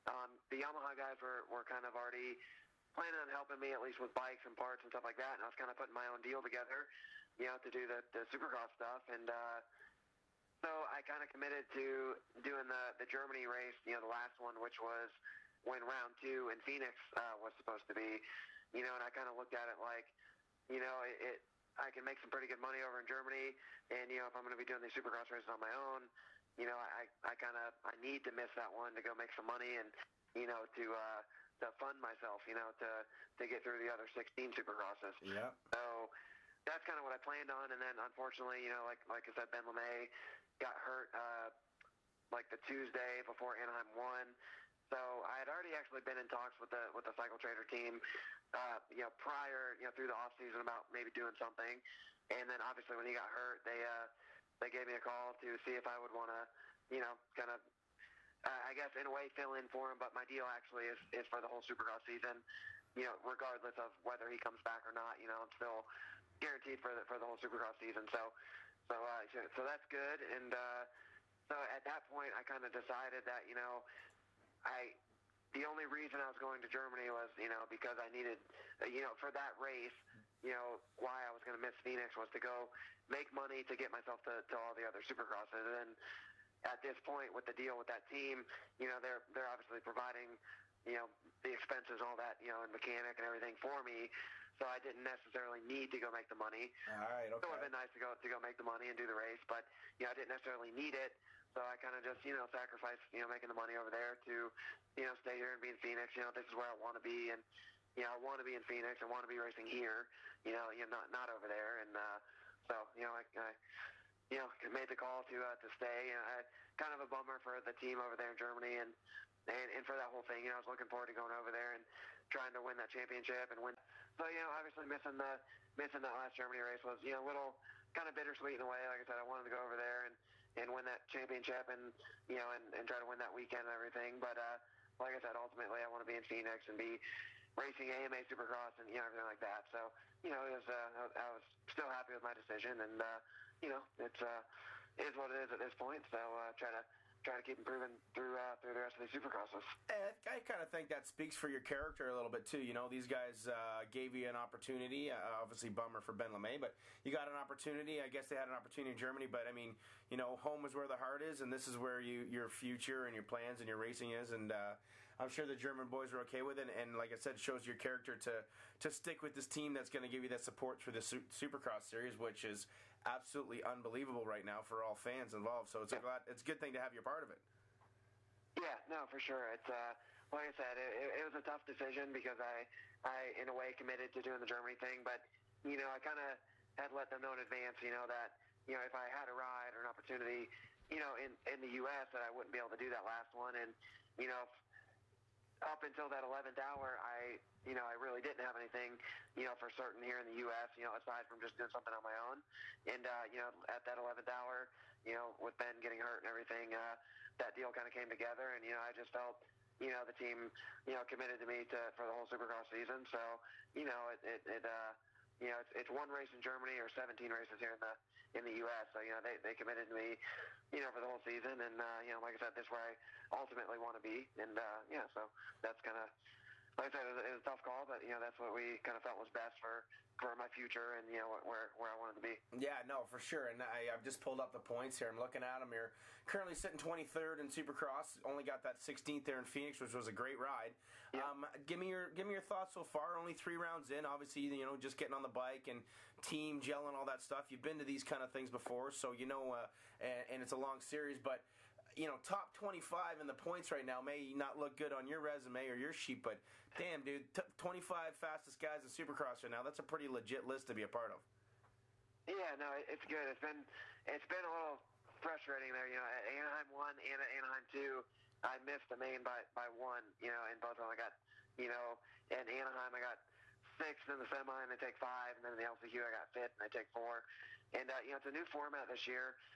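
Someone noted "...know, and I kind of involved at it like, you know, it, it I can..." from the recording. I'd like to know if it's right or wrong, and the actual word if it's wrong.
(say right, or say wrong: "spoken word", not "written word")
wrong: "looked", not "involved".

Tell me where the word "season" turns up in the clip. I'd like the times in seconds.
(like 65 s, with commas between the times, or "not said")
50 s, 62 s, 67 s, 212 s, 221 s.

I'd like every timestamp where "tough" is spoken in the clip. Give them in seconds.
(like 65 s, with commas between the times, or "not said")
181 s, 227 s.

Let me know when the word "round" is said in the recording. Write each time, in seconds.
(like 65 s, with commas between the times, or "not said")
15 s, 243 s.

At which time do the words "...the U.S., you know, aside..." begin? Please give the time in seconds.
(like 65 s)
200 s.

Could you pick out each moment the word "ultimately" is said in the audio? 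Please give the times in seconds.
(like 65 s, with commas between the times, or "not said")
135 s, 223 s.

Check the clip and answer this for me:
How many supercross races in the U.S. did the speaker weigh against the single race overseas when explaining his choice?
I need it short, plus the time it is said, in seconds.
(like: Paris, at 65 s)
17, at 216 s.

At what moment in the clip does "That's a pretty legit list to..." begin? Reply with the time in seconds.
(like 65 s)
259 s.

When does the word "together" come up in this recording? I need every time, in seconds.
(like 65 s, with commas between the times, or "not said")
6 s, 208 s.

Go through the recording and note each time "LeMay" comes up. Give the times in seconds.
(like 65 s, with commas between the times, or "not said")
39 s, 156 s.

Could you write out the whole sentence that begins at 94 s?
So I didn't necessarily need to go make the money.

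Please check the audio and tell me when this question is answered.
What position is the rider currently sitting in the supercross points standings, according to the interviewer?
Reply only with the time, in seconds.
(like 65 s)
236 s.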